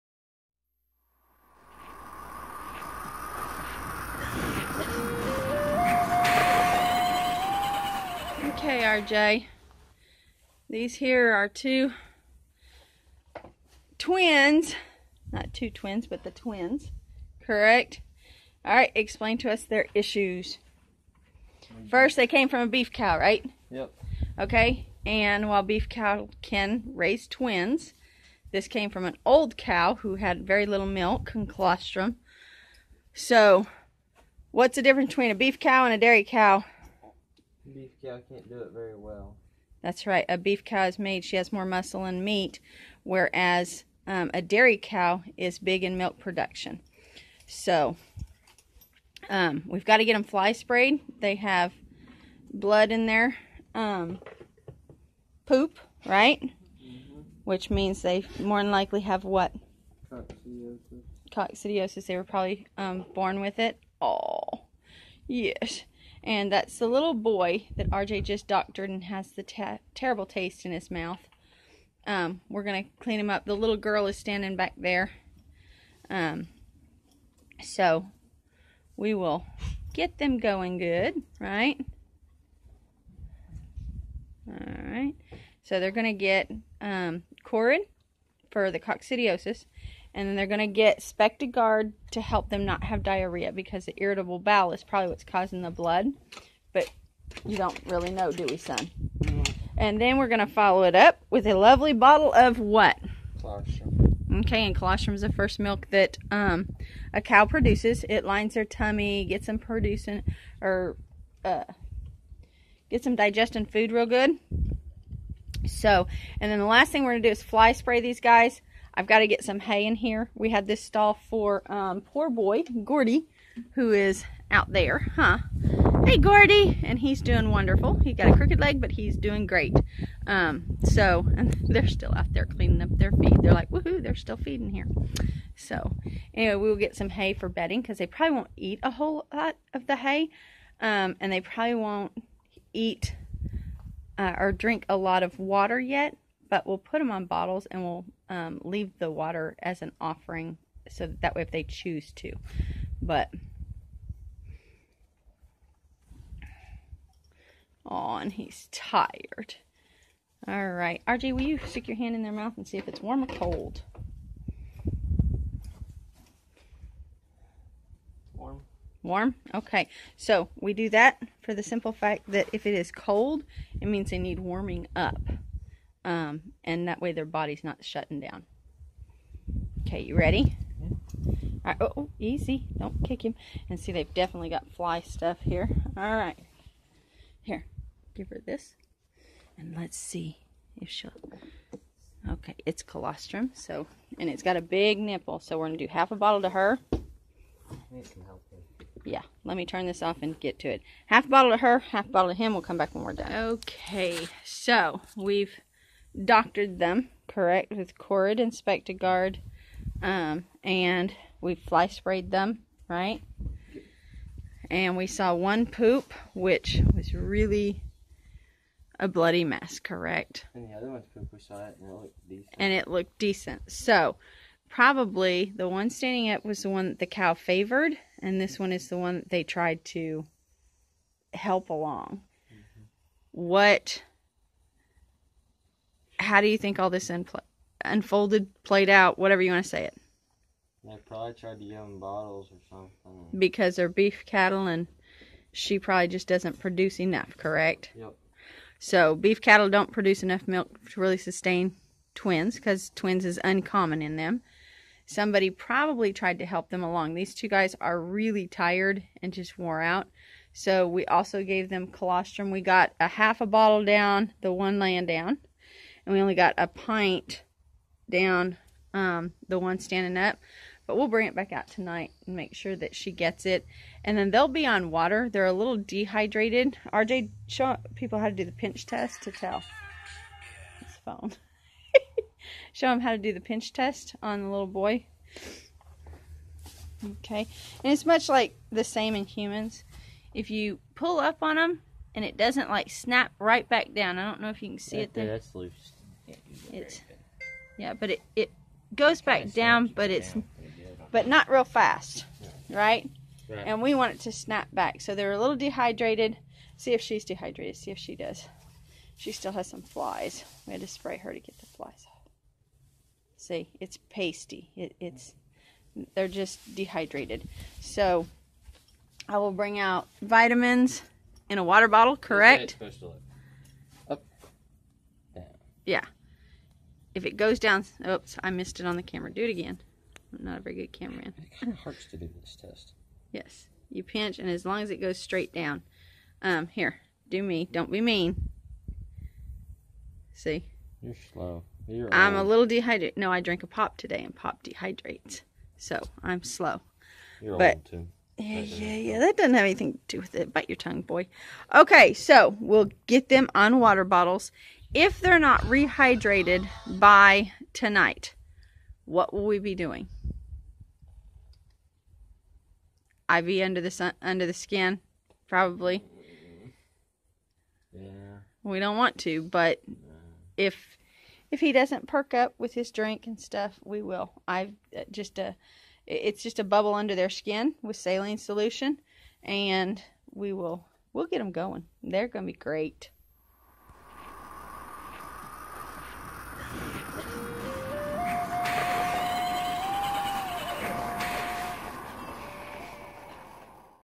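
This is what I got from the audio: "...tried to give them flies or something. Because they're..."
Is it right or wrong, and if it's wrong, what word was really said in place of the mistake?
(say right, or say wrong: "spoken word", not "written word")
wrong: "bottles", not "flies".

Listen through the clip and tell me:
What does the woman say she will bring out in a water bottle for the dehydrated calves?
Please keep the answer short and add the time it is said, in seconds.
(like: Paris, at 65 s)
vitamins, at 320 s.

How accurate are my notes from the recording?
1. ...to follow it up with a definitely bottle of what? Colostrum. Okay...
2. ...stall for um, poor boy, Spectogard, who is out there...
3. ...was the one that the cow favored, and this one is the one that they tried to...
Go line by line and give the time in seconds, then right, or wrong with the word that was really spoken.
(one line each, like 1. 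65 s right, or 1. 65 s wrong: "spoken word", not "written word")
1. 100 s wrong: "lovely", not "definitely"
2. 120 s wrong: "Gordy", not "Spectogard"
3. 226 s right.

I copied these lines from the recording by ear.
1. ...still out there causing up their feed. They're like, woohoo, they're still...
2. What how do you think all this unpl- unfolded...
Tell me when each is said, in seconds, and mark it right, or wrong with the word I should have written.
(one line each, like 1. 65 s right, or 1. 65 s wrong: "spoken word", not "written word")
1. 131 s wrong: "cleaning", not "causing"
2. 233 s right.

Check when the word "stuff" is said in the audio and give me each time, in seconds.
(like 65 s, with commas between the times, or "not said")
185 s, 373 s.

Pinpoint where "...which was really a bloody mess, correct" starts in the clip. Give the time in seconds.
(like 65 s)
216 s.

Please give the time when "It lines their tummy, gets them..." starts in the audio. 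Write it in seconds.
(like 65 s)
108 s.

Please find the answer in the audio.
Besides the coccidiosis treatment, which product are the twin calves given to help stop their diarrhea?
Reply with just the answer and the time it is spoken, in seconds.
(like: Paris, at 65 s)
Spectogard, at 90 s.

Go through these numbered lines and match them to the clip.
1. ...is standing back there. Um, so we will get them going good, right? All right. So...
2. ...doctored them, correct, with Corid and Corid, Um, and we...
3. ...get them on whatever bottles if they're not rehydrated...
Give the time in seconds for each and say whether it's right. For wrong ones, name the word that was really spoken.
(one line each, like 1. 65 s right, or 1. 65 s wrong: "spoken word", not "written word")
1. 74 s right
2. 206 s wrong: "Guard", not "Corid"
3. 353 s wrong: "water", not "whatever".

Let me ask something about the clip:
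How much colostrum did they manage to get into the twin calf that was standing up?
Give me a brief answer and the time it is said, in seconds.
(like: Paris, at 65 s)
a pint, at 266 s.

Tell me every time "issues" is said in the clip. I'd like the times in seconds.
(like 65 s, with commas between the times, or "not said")
19 s.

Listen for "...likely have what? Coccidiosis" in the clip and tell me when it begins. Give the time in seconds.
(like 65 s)
58 s.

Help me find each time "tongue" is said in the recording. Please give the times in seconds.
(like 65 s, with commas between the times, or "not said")
350 s.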